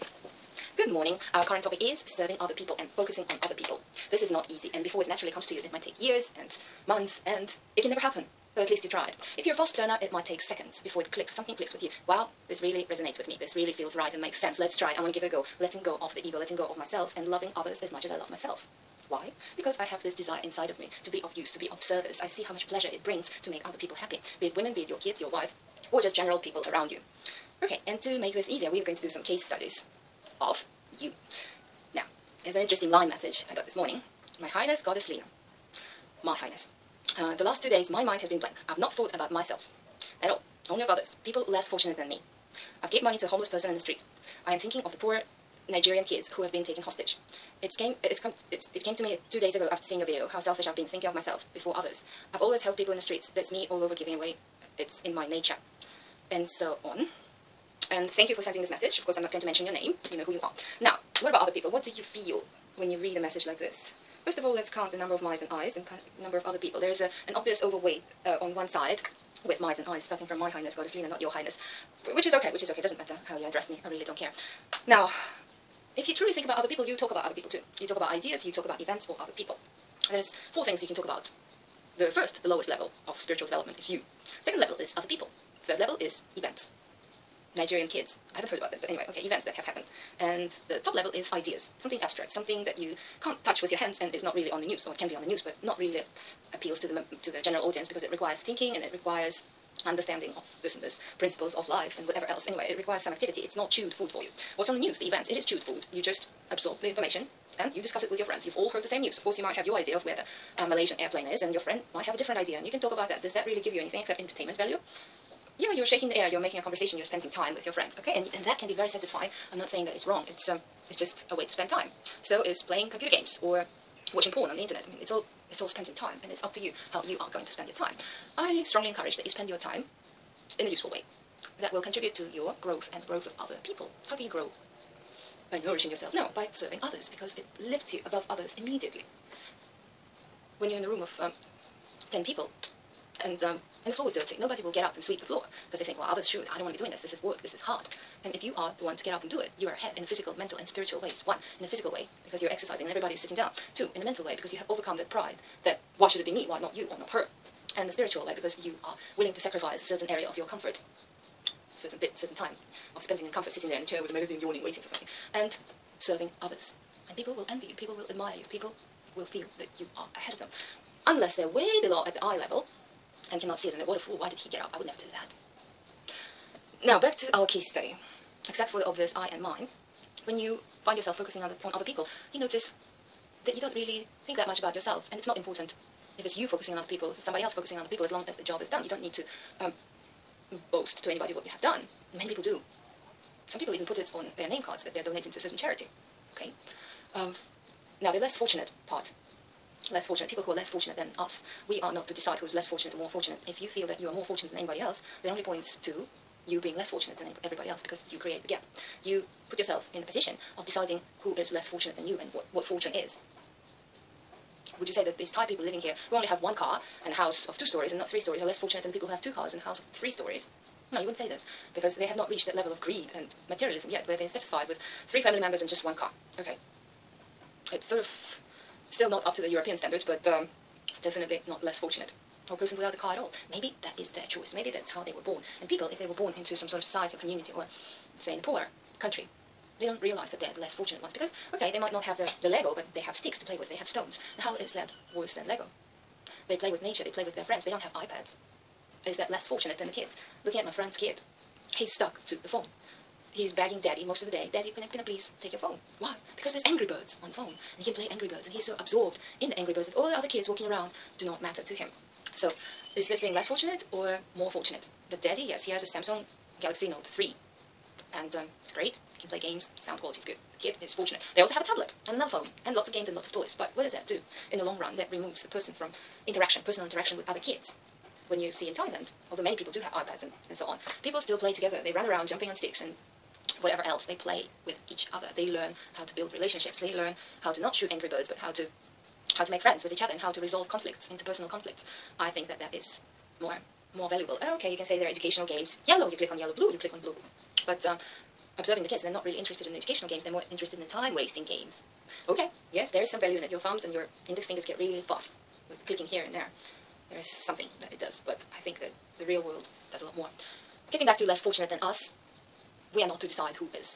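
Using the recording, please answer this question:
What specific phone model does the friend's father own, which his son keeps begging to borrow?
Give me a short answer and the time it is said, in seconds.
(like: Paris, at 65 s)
Samsung Galaxy Note 3, at 265 s.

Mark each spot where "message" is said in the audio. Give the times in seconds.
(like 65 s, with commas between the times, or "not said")
33 s, 58 s, 63 s.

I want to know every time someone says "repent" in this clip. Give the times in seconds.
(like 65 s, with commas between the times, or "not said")
not said.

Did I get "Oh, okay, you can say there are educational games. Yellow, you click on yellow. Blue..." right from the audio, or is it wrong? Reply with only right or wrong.
right.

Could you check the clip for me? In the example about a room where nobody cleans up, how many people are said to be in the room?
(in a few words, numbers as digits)
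10.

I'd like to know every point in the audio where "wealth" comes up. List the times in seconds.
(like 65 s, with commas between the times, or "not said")
not said.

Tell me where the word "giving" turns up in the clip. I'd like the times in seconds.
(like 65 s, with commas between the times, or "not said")
53 s.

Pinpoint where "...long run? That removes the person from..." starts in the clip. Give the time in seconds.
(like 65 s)
274 s.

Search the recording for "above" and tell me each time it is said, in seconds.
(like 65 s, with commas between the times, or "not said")
138 s.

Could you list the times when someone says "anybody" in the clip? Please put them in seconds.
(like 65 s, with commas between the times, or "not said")
191 s, 204 s.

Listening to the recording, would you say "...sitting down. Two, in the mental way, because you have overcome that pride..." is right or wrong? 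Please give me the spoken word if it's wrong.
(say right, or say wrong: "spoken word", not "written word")
right.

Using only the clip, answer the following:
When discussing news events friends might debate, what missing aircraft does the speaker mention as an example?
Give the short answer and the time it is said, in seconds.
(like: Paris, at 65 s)
Malaysian airplane, at 110 s.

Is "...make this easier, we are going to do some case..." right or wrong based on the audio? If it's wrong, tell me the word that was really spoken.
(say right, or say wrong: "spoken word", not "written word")
right.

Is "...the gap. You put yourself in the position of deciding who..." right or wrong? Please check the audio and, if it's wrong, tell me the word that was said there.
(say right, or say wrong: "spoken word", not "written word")
right.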